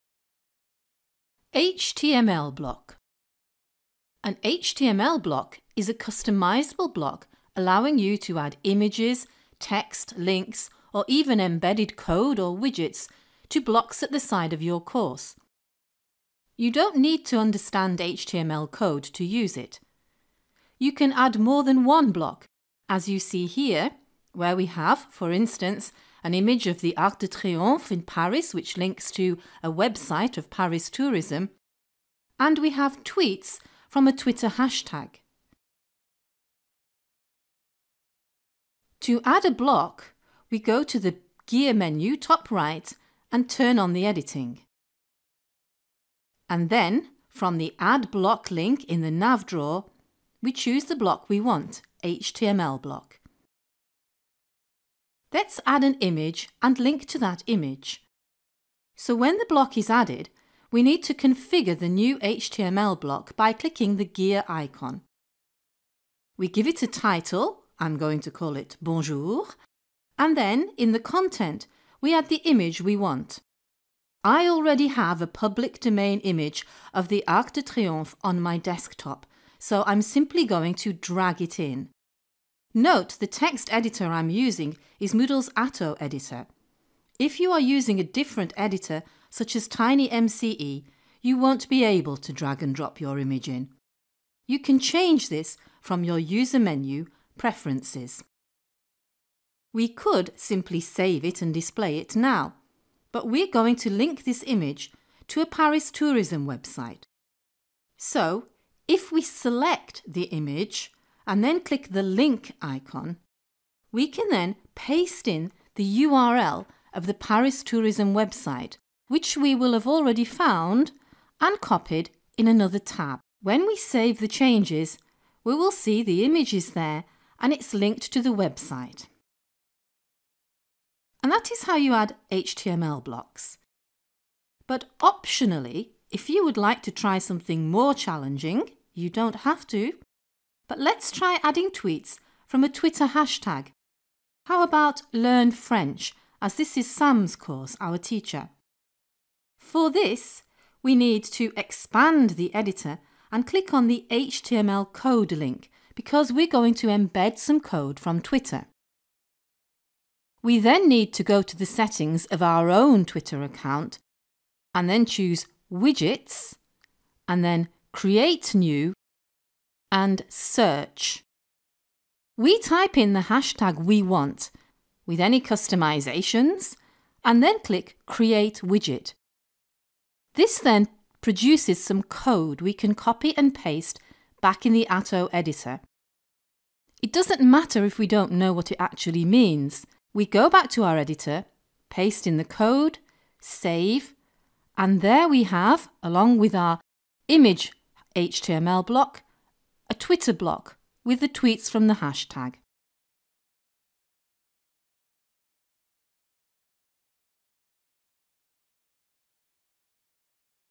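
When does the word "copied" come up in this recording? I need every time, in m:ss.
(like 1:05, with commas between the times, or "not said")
2:01.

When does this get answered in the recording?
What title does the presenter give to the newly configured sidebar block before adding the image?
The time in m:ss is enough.
1:08.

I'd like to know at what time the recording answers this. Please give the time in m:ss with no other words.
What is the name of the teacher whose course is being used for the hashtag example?
2:26.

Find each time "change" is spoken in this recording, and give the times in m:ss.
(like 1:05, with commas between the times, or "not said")
1:34, 2:04.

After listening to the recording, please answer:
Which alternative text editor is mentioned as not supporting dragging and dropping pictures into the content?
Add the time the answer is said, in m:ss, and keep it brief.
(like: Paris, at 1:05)
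TinyMCE, at 1:29.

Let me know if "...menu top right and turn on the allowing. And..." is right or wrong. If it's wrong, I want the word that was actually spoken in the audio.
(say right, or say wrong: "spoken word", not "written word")
wrong: "editing", not "allowing".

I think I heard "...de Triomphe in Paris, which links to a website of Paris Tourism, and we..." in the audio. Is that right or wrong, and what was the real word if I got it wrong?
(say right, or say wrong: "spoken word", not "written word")
right.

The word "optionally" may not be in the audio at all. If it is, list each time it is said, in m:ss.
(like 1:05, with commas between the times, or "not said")
2:14.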